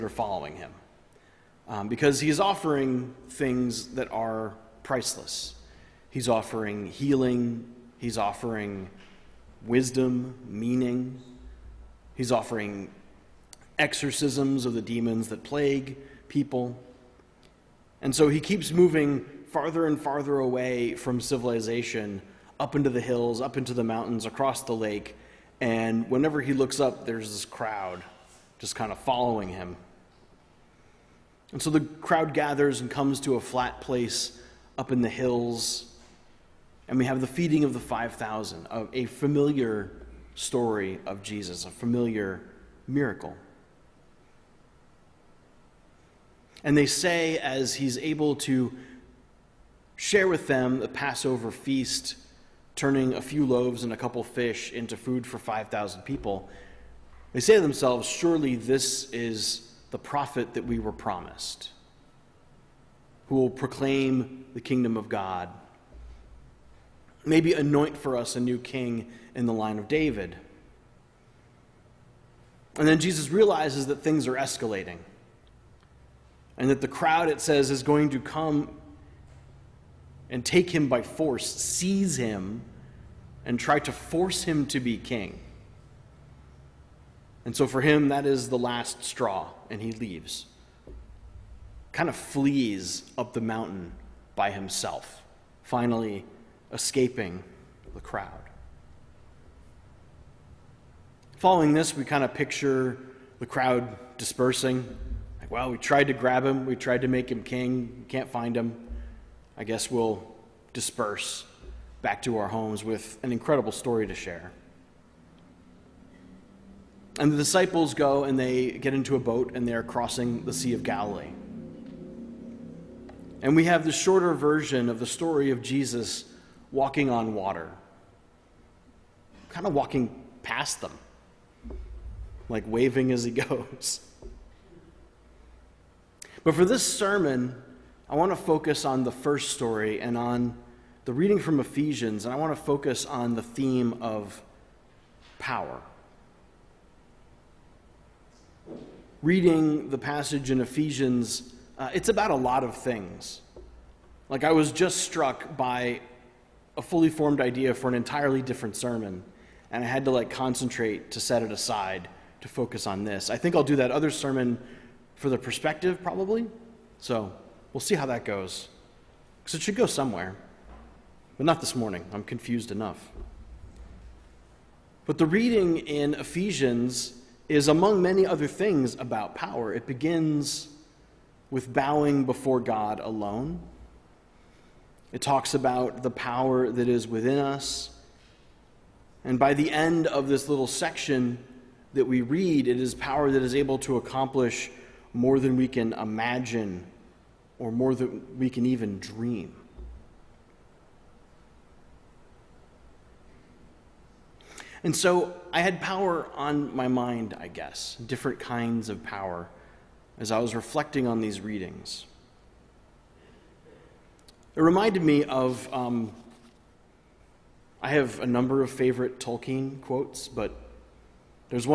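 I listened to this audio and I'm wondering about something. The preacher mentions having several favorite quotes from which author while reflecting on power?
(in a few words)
Tolkien.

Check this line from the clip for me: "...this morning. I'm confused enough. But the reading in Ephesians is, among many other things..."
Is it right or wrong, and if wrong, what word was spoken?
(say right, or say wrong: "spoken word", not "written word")
right.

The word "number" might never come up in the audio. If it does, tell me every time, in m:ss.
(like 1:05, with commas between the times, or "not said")
3:38.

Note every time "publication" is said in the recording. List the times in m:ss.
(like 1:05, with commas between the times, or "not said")
not said.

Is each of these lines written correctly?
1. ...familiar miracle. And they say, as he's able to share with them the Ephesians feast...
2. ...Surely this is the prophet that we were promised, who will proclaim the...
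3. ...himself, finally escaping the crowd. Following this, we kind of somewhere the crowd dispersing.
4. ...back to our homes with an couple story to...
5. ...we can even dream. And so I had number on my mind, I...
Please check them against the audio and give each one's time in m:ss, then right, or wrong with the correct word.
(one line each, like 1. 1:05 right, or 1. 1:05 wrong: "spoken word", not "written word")
1. 0:41 wrong: "Passover", not "Ephesians"
2. 0:58 right
3. 1:34 wrong: "picture", not "somewhere"
4. 1:52 wrong: "incredible", not "couple"
5. 3:18 wrong: "power", not "number".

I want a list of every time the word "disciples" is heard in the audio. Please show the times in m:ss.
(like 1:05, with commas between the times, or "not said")
1:57.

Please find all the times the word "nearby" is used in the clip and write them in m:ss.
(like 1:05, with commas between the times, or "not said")
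not said.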